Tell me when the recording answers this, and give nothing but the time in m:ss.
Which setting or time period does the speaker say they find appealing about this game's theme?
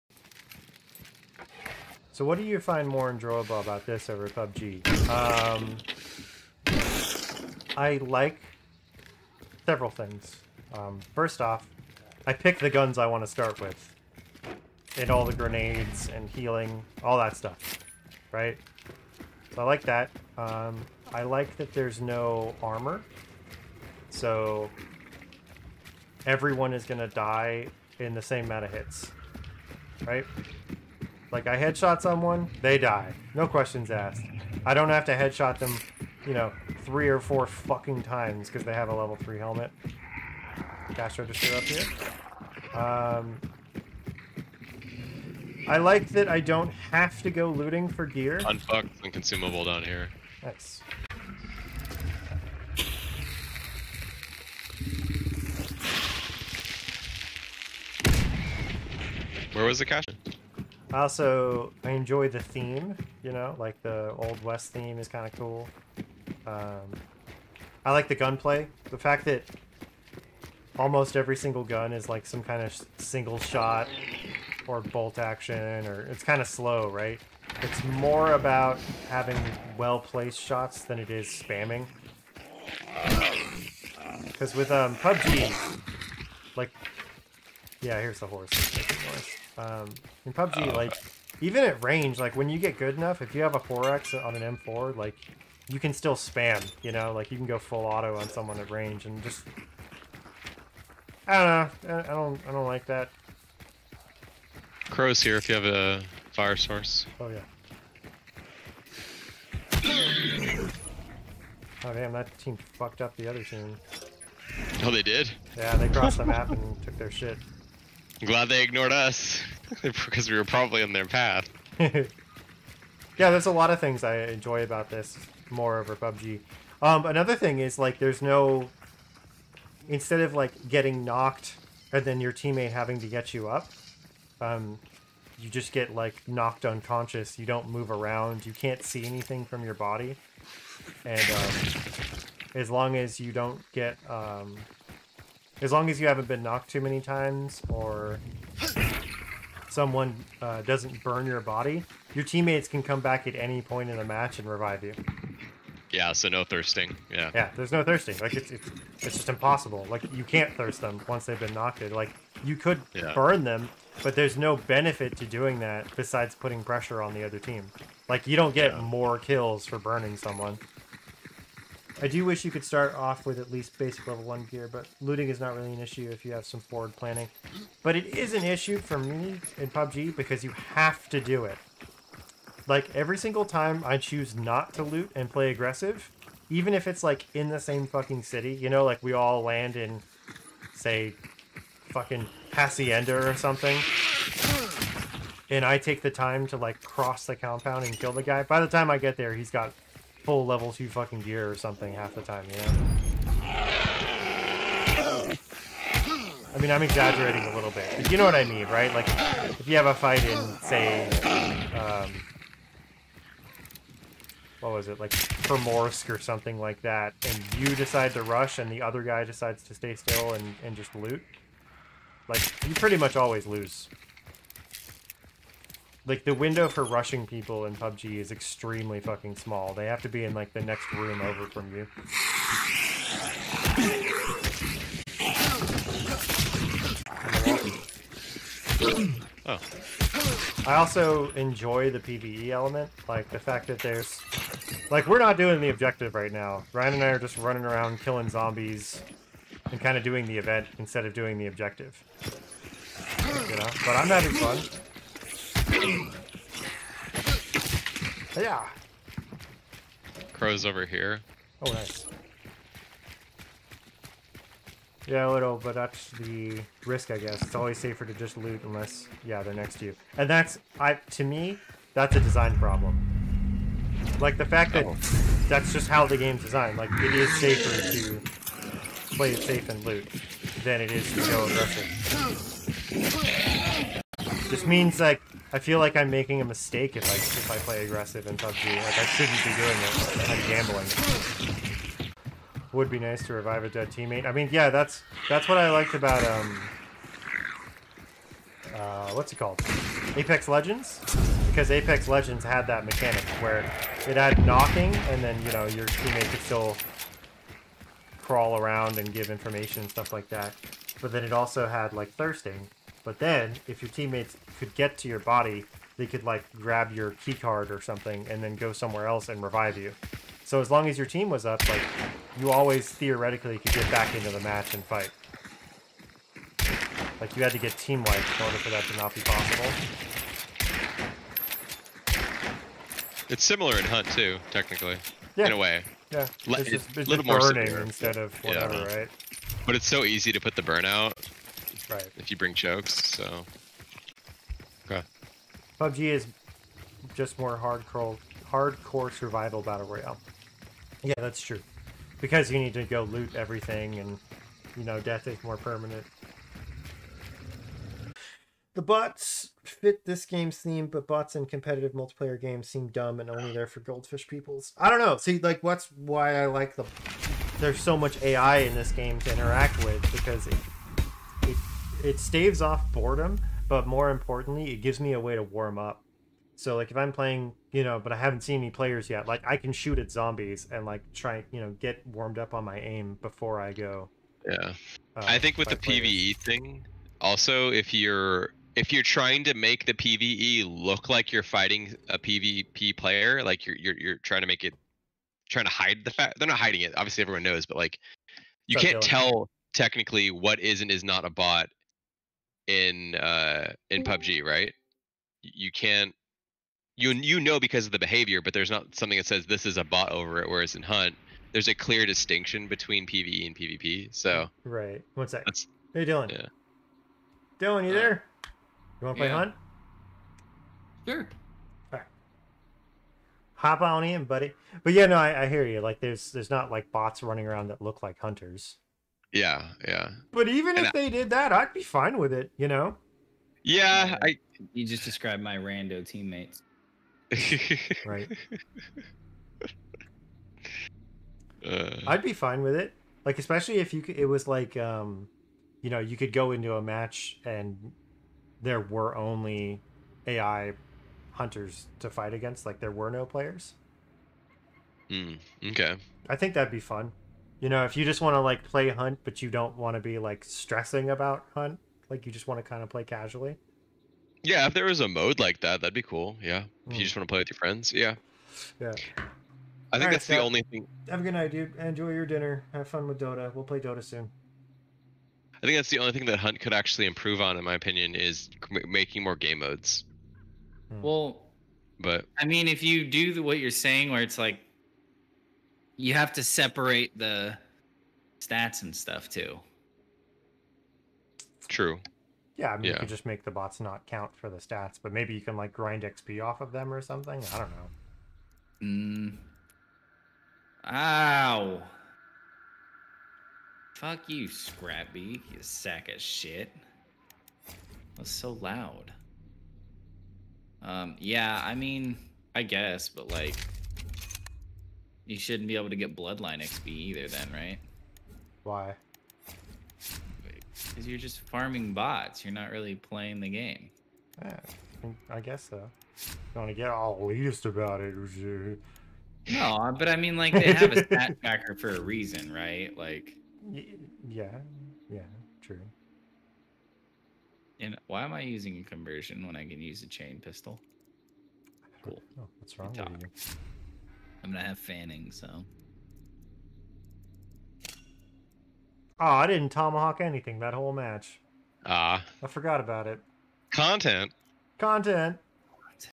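1:04.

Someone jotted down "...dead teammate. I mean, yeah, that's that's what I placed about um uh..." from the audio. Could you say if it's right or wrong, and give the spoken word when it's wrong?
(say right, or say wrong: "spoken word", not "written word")
wrong: "liked", not "placed".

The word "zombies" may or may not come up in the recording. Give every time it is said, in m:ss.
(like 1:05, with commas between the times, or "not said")
4:08, 6:20.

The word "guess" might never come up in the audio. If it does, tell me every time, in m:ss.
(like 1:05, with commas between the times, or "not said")
4:27, 8:32, 8:45.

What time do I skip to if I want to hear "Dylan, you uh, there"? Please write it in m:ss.
6:57.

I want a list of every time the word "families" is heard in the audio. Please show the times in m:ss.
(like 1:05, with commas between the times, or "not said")
not said.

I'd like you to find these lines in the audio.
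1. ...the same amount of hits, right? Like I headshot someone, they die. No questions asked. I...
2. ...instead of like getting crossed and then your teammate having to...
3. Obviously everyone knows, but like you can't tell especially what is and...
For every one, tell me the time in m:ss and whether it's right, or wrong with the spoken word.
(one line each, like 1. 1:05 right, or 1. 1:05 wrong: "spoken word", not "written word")
1. 0:28 right
2. 2:09 wrong: "knocked", not "crossed"
3. 6:36 wrong: "technically", not "especially".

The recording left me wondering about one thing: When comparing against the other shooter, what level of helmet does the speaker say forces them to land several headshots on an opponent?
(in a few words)
level three.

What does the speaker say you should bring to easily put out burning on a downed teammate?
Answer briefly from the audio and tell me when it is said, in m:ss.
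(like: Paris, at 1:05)
chokes, at 5:42.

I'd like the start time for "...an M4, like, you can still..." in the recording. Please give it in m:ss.
1:34.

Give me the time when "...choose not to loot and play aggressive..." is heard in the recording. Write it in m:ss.
3:03.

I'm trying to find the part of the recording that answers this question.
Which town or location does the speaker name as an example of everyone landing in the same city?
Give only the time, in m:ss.
3:12.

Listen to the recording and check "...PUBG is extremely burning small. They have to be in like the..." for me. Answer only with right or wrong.
wrong.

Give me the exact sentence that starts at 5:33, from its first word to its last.
It's similar in Hunt too, technically.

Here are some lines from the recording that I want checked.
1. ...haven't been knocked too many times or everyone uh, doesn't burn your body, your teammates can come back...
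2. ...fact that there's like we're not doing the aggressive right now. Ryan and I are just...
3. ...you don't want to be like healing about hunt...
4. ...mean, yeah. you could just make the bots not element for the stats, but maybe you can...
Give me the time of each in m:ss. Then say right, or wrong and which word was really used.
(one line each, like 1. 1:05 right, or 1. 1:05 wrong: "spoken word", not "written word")
1. 2:26 wrong: "someone", not "everyone"
2. 4:03 wrong: "objective", not "aggressive"
3. 7:39 wrong: "stressing", not "healing"
4. 8:12 wrong: "count", not "element".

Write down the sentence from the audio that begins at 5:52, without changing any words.
Because you need to go loot everything, and you know, death is more permanent.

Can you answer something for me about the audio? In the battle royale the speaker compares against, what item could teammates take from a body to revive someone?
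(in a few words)
key card.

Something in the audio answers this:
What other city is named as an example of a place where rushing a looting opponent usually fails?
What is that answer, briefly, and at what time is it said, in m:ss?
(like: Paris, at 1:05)
Primorsk, at 3:35.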